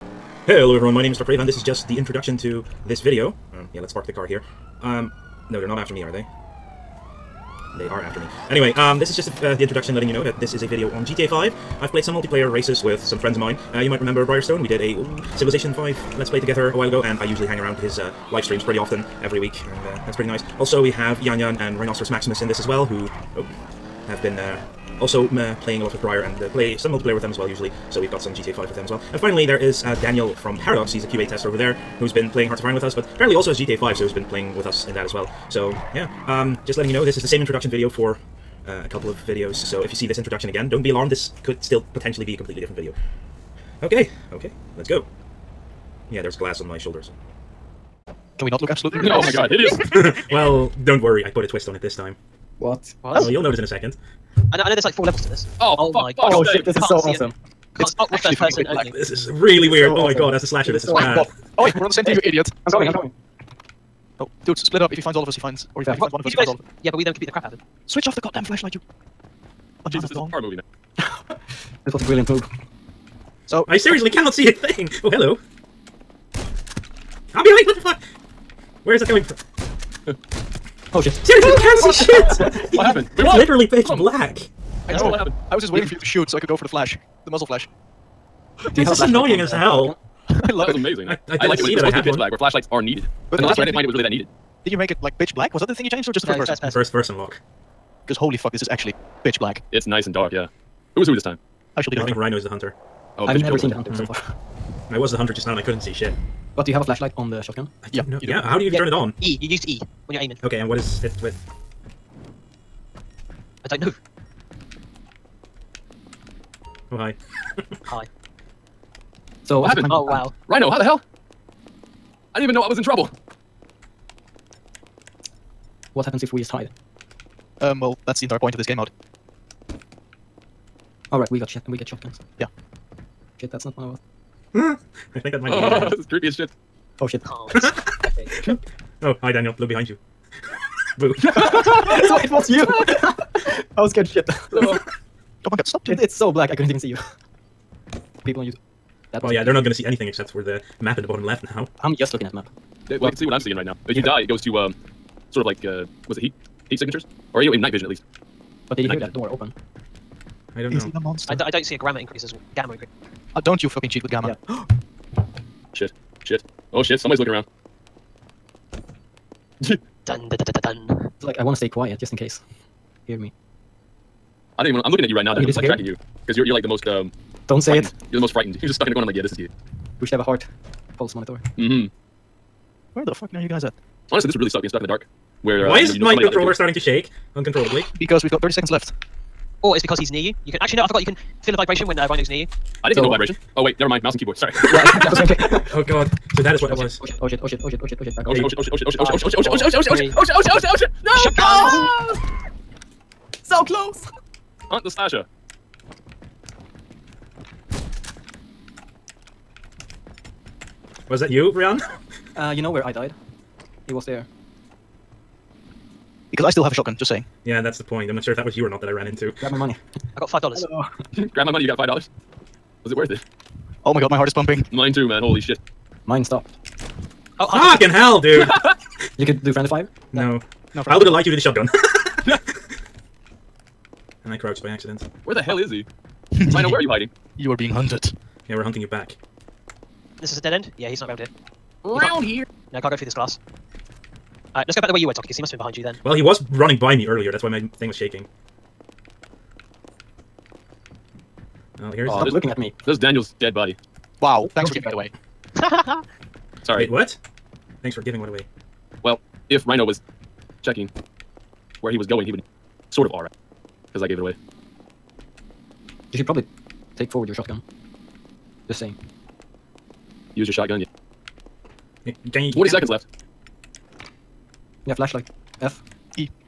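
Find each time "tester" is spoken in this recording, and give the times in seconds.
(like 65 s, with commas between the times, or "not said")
31 s.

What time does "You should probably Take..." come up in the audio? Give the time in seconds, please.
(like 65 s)
266 s.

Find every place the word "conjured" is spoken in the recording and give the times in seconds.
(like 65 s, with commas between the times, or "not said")
not said.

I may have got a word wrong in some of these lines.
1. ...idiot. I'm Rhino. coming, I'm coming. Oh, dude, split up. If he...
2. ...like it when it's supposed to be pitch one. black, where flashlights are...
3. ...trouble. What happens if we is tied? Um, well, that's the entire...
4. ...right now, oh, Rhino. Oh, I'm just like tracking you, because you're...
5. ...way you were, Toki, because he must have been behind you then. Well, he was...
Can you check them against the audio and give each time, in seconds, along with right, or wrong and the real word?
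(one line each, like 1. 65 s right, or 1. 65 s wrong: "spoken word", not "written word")
1. 62 s wrong: "Sorry", not "Rhino"
2. 91 s right
3. 122 s right
4. 175 s wrong: "Dan", not "Rhino"
5. 244 s right.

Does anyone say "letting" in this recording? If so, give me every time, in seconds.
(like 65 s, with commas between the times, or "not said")
9 s, 36 s.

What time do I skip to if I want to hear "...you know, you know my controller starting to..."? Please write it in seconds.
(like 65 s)
185 s.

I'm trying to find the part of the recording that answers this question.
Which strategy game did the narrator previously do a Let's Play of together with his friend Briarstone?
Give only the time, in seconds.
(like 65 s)
15 s.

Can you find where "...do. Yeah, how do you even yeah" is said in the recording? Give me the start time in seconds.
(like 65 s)
108 s.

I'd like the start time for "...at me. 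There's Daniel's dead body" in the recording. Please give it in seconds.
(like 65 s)
252 s.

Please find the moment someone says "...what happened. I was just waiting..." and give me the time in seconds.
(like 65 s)
85 s.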